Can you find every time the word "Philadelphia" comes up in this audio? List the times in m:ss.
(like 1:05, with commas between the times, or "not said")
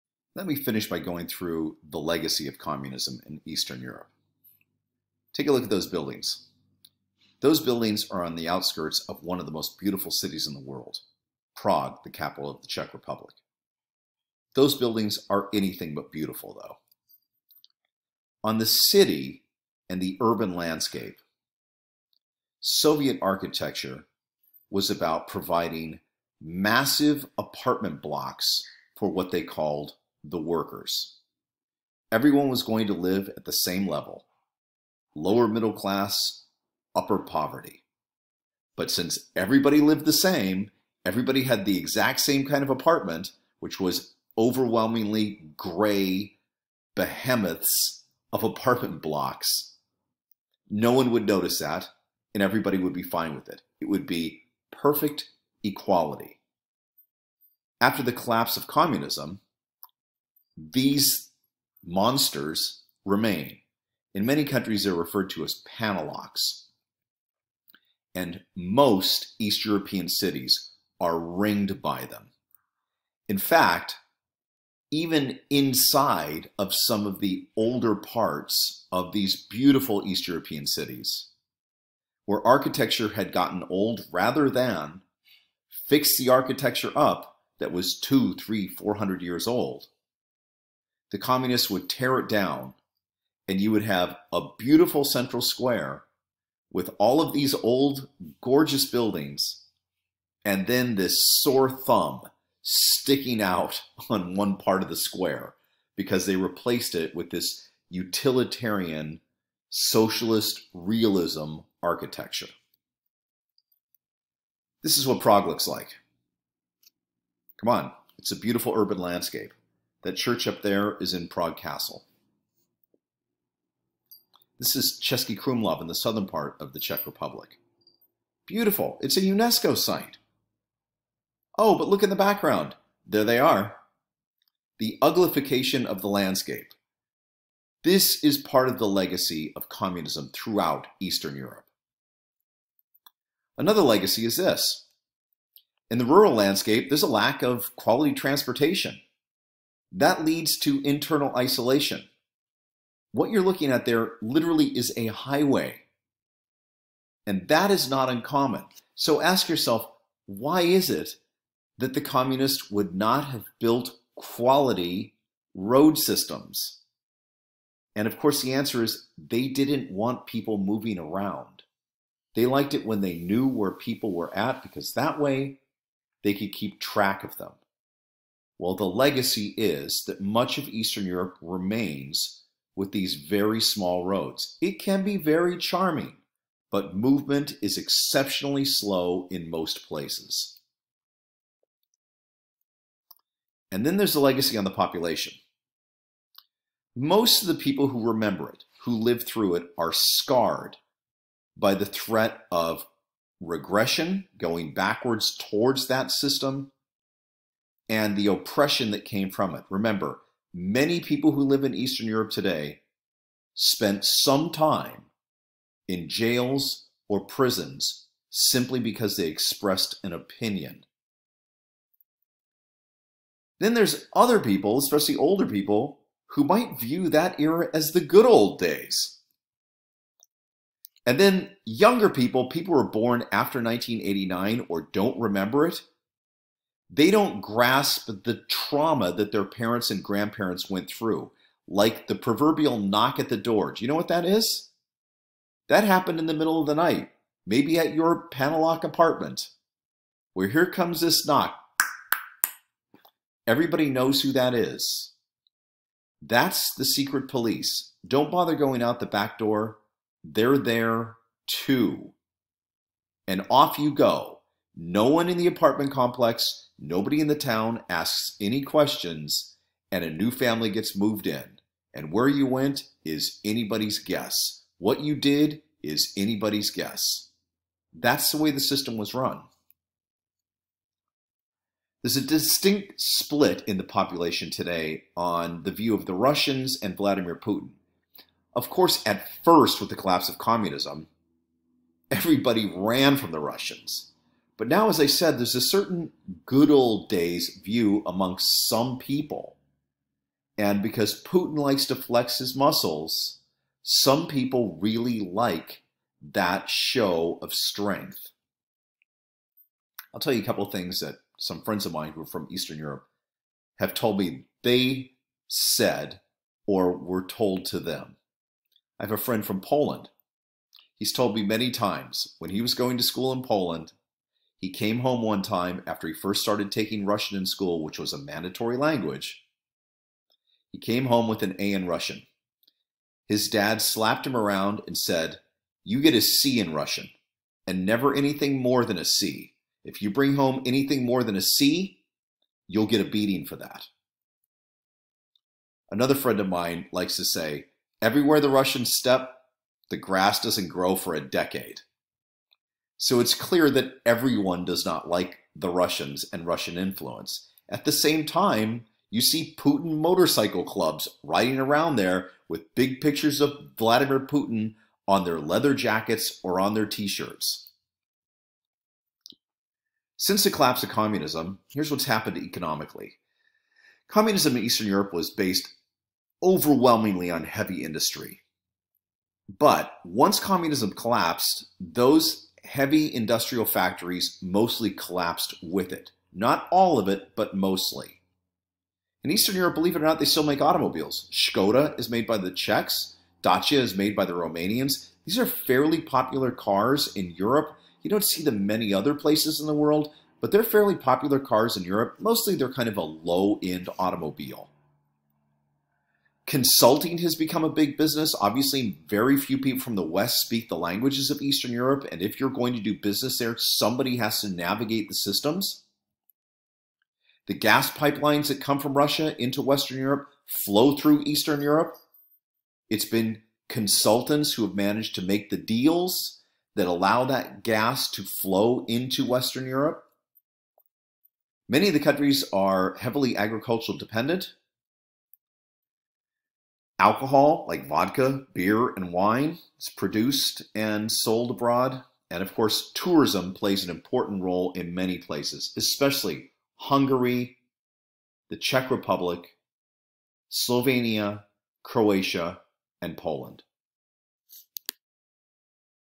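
not said.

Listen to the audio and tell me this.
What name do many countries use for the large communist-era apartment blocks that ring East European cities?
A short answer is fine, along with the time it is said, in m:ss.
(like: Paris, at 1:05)
paneláks, at 1:05.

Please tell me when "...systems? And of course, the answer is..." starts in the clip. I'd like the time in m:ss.
2:45.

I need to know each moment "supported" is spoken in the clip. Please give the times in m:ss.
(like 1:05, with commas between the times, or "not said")
not said.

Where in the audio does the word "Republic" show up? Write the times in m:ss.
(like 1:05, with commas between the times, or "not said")
0:12, 2:07, 7:28.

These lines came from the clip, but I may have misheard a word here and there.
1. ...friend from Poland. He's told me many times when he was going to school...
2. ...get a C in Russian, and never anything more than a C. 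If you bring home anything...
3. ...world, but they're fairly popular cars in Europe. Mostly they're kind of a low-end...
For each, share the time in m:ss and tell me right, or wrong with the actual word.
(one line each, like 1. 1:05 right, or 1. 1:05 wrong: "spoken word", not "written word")
1. 5:19 right
2. 5:35 right
3. 6:39 right.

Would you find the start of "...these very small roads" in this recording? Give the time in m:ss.
3:02.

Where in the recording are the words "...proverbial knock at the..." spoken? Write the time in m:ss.
4:02.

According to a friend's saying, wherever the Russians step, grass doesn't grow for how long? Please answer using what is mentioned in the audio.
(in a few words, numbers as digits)
a decade.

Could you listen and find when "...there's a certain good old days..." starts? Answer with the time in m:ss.
4:55.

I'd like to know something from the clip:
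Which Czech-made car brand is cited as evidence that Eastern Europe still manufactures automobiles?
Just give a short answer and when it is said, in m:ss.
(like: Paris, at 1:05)
Skoda, at 6:31.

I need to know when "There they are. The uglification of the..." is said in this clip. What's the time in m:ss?
2:13.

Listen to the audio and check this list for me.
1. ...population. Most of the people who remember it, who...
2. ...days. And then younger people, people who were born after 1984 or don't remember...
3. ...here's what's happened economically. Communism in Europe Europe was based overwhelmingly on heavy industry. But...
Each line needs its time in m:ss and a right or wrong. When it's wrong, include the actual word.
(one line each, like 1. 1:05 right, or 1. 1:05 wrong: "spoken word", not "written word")
1. 3:14 right
2. 3:48 wrong: "1989", not "1984"
3. 6:11 wrong: "Eastern", not "Europe".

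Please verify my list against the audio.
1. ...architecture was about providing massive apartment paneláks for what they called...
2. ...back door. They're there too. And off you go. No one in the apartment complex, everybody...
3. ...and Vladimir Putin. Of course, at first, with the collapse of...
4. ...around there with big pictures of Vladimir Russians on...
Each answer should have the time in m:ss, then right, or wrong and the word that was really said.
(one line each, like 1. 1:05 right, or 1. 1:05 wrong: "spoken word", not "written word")
1. 0:23 wrong: "blocks", not "paneláks"
2. 4:19 wrong: "nobody", not "everybody"
3. 4:46 right
4. 6:01 wrong: "Putin", not "Russians".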